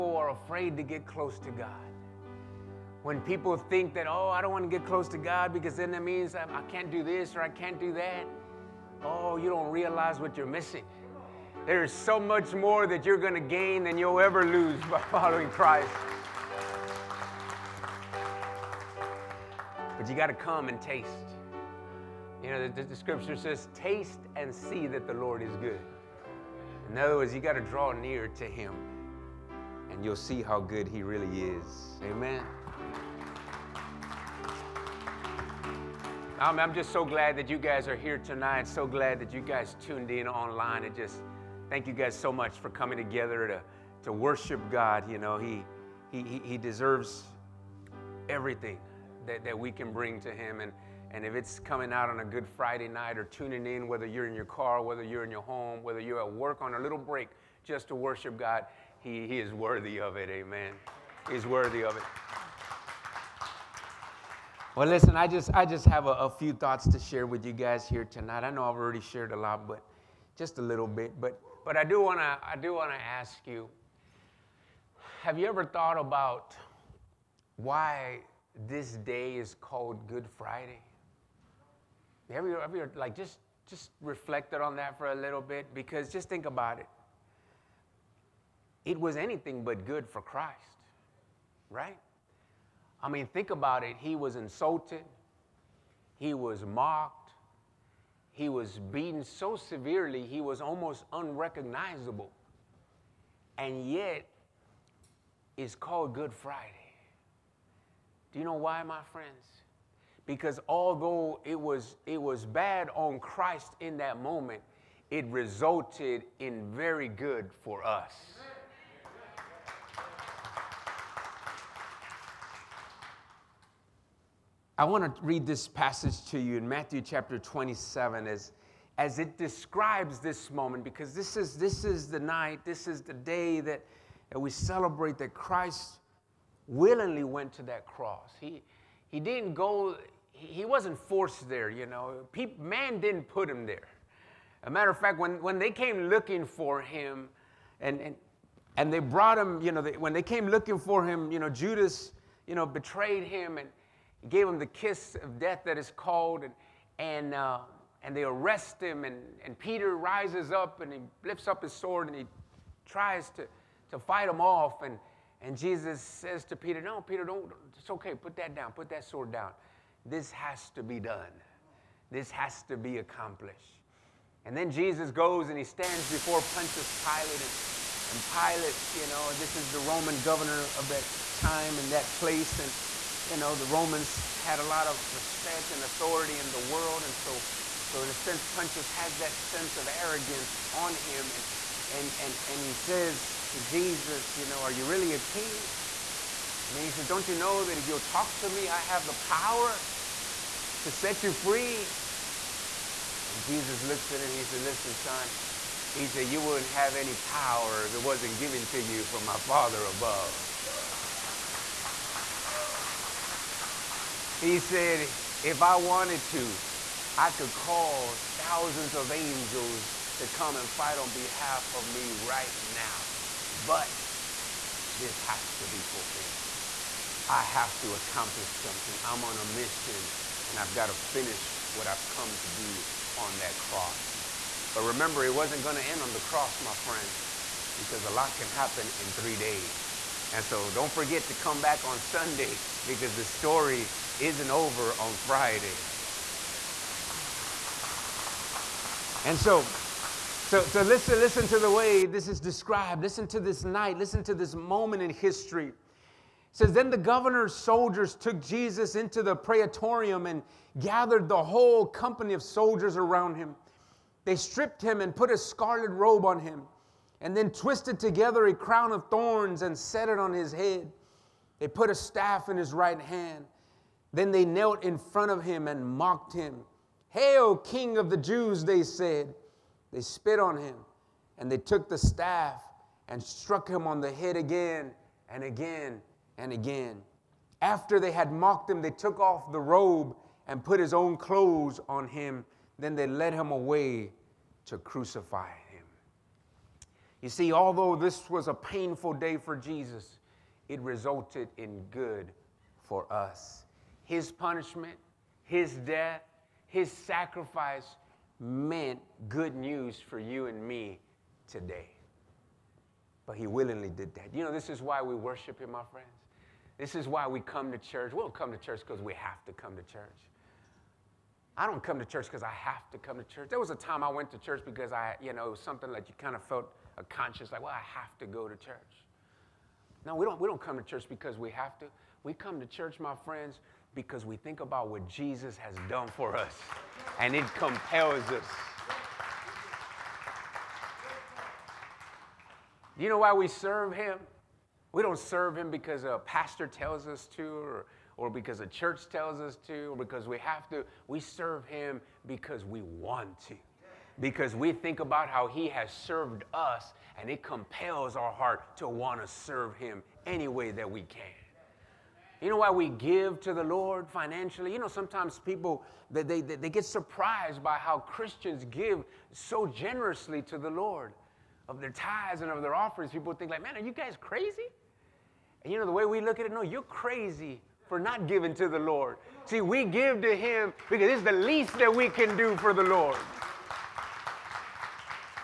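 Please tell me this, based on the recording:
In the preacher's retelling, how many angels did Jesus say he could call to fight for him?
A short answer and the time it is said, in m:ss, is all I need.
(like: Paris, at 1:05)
Thousands, at 3:38.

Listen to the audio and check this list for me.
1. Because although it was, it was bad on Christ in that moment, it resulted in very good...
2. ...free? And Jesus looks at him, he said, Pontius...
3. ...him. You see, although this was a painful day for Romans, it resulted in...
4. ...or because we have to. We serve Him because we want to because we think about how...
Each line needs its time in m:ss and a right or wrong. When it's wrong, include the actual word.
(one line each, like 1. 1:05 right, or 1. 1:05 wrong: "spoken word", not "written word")
1. 1:50 right
2. 3:21 wrong: "Listen", not "Pontius"
3. 4:55 wrong: "Jesus", not "Romans"
4. 5:49 right.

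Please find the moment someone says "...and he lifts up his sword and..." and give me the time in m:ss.
2:40.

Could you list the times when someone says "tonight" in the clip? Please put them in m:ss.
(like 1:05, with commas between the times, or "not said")
0:38, 1:08.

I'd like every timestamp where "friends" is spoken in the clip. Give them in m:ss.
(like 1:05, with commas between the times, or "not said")
1:49, 3:56, 5:15, 5:33.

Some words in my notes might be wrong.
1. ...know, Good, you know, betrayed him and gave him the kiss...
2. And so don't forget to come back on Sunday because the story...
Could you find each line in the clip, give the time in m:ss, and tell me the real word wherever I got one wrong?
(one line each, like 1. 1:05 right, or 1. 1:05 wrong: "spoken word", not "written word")
1. 2:31 wrong: "Judas", not "Good"
2. 4:00 right.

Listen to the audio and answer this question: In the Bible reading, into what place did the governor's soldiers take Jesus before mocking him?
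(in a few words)
The praetorium.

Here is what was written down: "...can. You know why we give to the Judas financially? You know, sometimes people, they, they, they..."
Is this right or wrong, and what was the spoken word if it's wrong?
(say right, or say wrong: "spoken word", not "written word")
wrong: "Lord", not "Judas".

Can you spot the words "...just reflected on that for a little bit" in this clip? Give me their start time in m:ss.
1:23.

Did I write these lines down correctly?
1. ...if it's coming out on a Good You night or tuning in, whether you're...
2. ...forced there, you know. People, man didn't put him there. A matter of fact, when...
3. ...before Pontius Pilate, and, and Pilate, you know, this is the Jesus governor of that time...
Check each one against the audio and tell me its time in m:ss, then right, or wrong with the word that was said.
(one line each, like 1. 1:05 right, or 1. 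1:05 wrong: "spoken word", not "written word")
1. 0:51 wrong: "Friday", not "You"
2. 2:21 right
3. 2:56 wrong: "Roman", not "Jesus".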